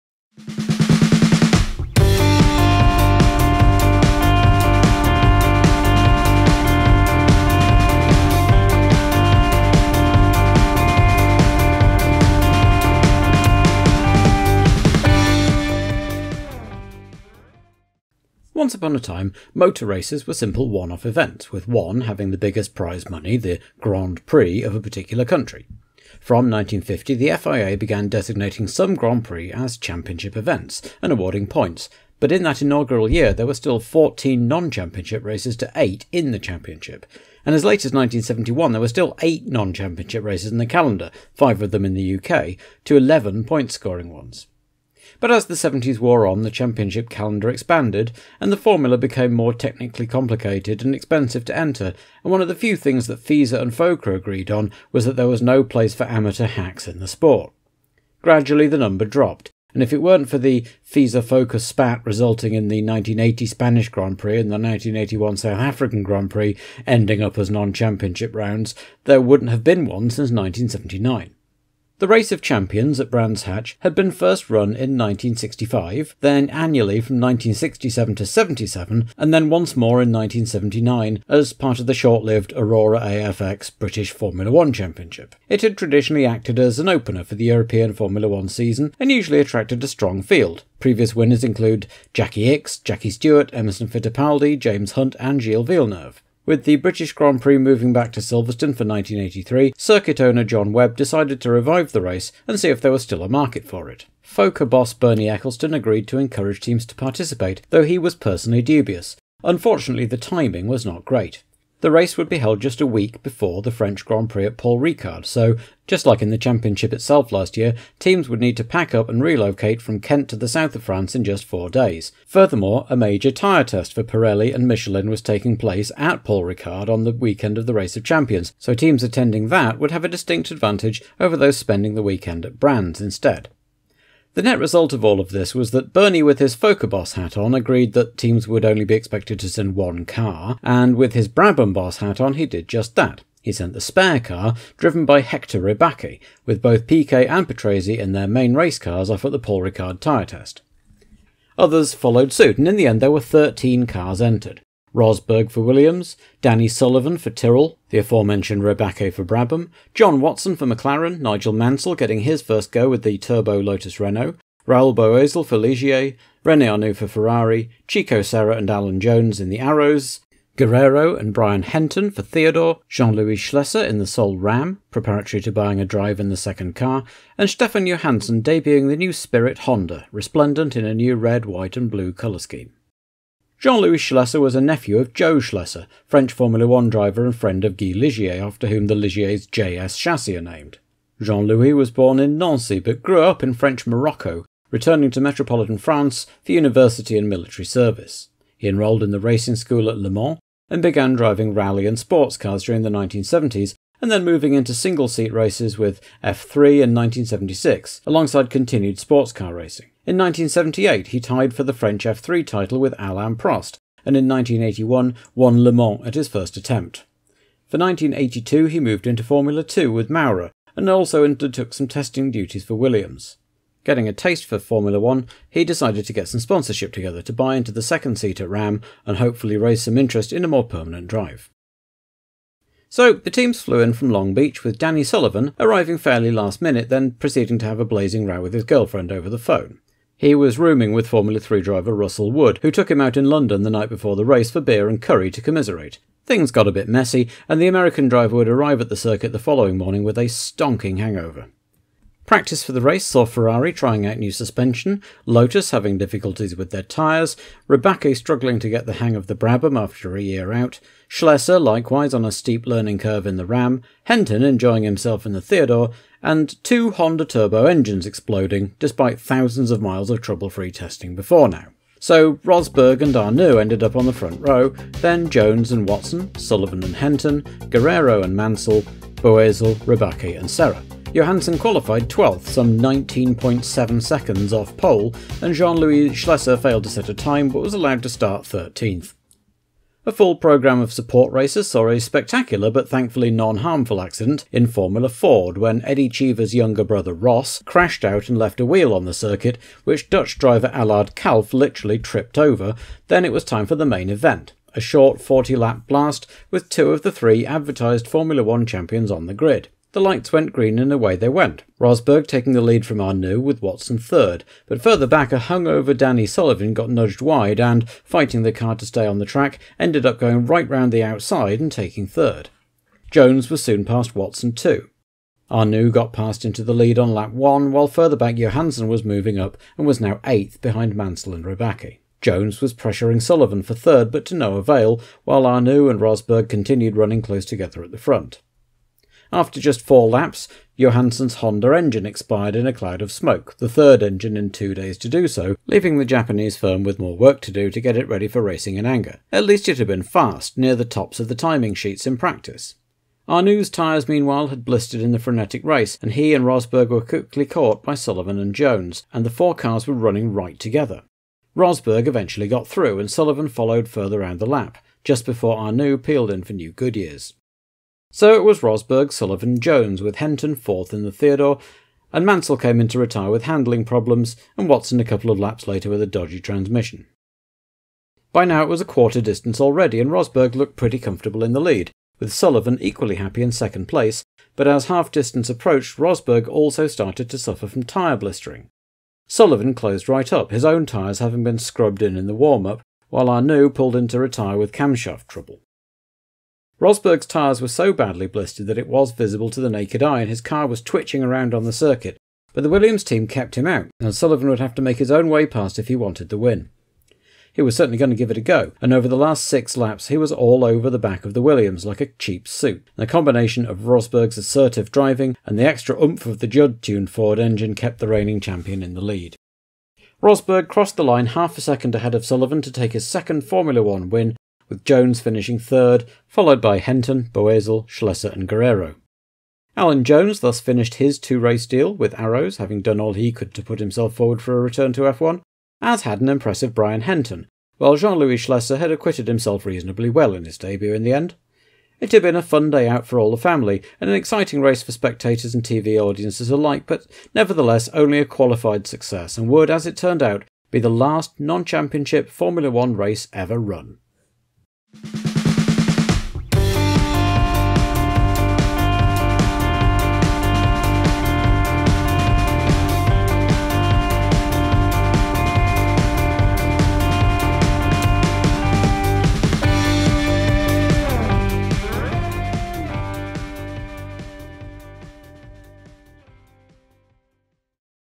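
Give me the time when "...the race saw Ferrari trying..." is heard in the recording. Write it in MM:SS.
04:12.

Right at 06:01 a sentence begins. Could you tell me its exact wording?
Rosberg eventually got through, and Sullivan followed further round the lap, just before Arnoux peeled in for New Goodyears.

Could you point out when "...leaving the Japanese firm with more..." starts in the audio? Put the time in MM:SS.
05:45.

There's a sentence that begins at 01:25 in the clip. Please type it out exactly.
It had traditionally acted as an opener for the European Formula One season and usually attracted a strong field.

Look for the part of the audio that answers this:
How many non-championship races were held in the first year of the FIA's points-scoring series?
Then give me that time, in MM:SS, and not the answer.
00:33.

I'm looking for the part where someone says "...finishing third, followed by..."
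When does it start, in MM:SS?
07:05.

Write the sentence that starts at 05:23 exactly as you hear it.
Jones was soon past Watson too.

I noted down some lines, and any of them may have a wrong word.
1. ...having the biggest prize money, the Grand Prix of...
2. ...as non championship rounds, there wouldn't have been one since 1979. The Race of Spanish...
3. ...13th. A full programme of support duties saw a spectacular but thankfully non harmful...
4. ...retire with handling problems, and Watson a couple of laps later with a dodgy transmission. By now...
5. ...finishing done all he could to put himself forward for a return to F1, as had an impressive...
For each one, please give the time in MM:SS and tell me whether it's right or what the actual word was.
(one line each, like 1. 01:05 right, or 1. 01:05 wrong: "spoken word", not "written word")
1. 00:22 right
2. 01:07 wrong: "Champions", not "Spanish"
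3. 04:48 wrong: "races", not "duties"
4. 06:12 right
5. 07:12 wrong: "having", not "finishing".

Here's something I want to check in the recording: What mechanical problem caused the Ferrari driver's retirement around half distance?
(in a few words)
Camshaft trouble.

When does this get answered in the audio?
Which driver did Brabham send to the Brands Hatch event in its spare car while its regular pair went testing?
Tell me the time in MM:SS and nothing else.
02:25.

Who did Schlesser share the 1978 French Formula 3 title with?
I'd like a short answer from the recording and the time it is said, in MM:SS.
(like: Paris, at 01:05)
Alain Prost, at 03:32.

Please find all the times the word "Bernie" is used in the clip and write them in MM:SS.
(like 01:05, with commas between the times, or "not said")
01:44, 02:15.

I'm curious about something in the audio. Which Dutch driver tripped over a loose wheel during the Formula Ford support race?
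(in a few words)
Allard Kalf.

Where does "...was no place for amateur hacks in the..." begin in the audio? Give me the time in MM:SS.
00:55.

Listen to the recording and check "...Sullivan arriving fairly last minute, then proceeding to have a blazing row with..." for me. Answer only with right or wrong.
right.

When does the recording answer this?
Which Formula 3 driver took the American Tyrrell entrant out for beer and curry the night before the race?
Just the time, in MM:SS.
04:01.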